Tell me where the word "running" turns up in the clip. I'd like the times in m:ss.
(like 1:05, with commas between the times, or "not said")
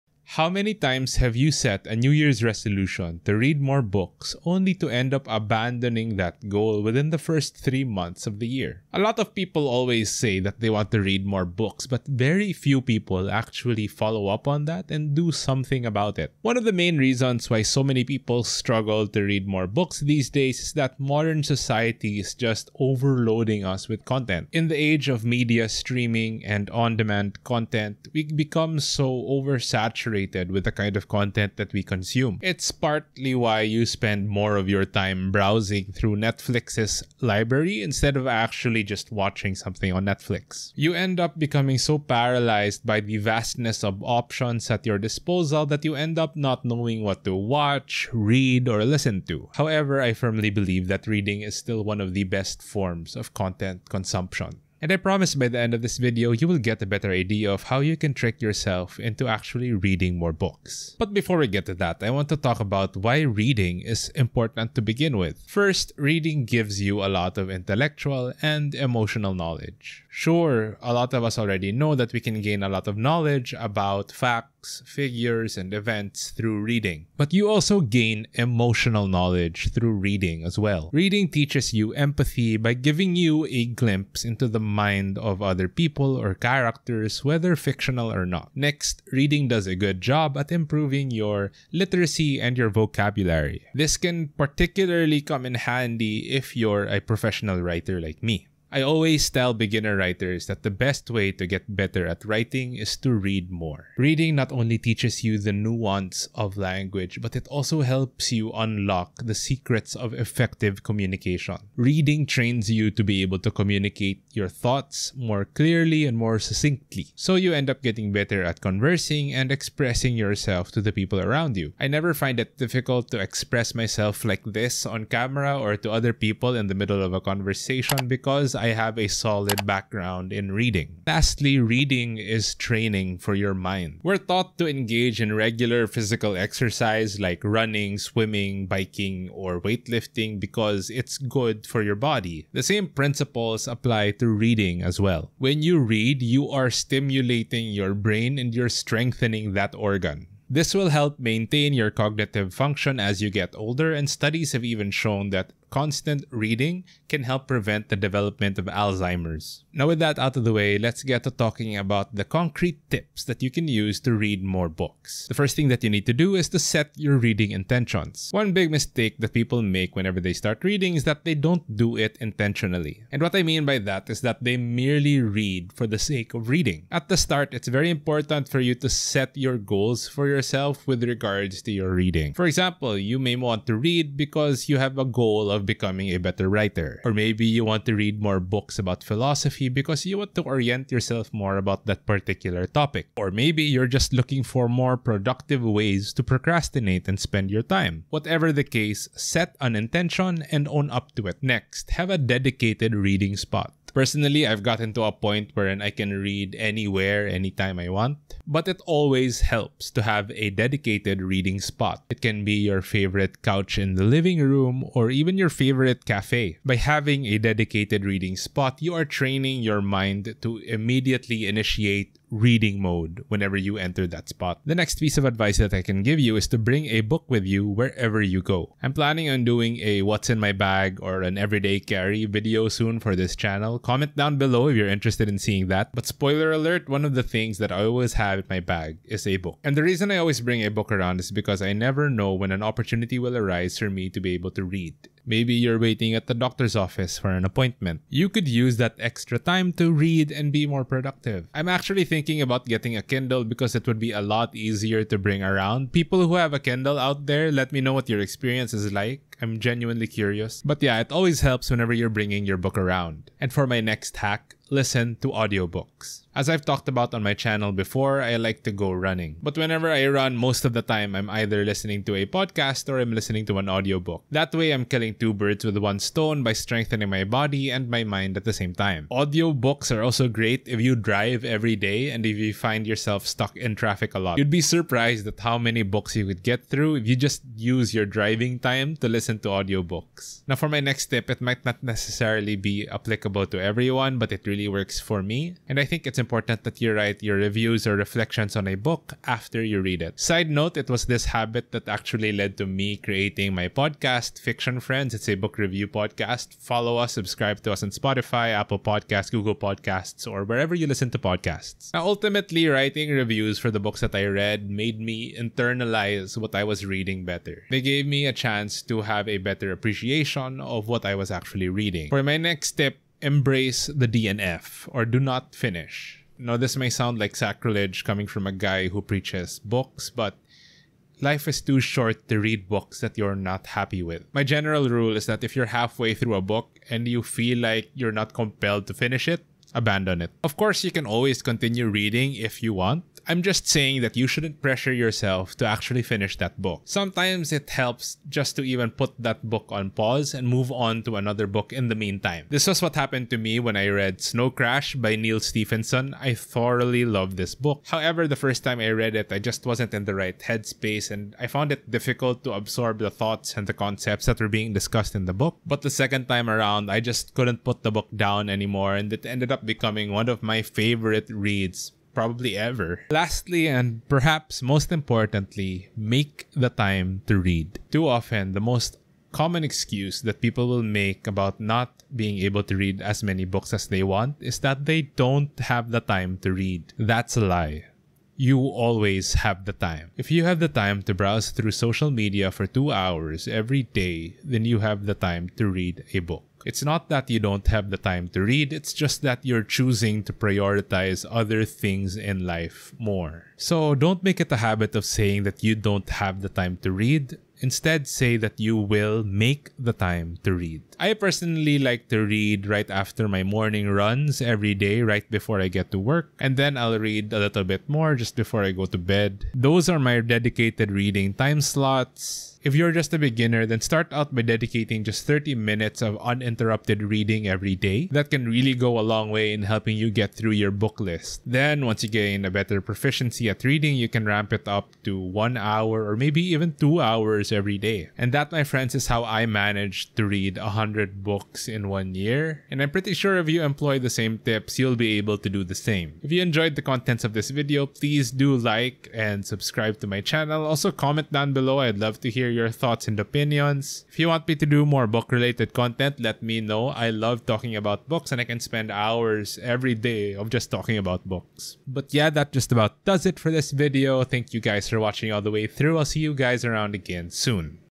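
2:17, 4:28.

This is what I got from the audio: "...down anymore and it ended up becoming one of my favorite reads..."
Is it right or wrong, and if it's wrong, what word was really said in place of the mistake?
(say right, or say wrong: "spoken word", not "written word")
right.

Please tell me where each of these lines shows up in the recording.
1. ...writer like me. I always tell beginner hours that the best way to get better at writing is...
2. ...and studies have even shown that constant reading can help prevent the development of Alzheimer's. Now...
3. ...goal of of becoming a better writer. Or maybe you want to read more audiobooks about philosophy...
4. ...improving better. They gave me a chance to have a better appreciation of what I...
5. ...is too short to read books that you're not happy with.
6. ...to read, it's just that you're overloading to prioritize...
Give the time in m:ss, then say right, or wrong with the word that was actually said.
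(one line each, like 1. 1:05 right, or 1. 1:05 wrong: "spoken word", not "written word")
1. 1:37 wrong: "writers", not "hours"
2. 2:33 right
3. 3:05 wrong: "books", not "audiobooks"
4. 5:16 wrong: "reading", not "improving"
5. 5:31 right
6. 6:38 wrong: "choosing", not "overloading".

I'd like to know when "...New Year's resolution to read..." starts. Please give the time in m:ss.
0:01.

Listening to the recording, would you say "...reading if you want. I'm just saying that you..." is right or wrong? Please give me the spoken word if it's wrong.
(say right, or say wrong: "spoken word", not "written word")
right.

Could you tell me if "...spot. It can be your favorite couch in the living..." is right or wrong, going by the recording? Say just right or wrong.
right.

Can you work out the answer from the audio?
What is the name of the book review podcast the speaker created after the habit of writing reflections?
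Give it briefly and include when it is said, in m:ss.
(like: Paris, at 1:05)
Fiction Friends, at 5:04.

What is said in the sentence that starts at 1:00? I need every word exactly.
But before we get to that, I want to talk about why reading is important to begin with.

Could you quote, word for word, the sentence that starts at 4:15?
People who have a Kindle out there, let me know what your experience is like.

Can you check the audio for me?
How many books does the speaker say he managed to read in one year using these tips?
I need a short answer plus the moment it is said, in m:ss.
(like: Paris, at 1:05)
100, at 7:20.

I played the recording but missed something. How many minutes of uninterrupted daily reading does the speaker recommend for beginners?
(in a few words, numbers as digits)
30.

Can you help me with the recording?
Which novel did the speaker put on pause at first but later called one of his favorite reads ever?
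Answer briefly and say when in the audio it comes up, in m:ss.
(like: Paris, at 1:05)
Snow Crash, at 5:54.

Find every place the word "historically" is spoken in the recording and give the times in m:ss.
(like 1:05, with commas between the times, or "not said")
not said.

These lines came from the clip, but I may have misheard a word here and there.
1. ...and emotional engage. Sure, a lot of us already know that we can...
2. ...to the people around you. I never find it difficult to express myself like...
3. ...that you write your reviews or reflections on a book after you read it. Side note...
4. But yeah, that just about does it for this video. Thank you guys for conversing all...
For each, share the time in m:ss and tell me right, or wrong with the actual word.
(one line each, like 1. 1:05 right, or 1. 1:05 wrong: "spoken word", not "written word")
1. 1:08 wrong: "knowledge", not "engage"
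2. 2:00 right
3. 4:56 right
4. 7:41 wrong: "watching", not "conversing".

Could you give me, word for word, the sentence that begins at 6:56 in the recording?
And then I'll read a little bit more just before I go to bed.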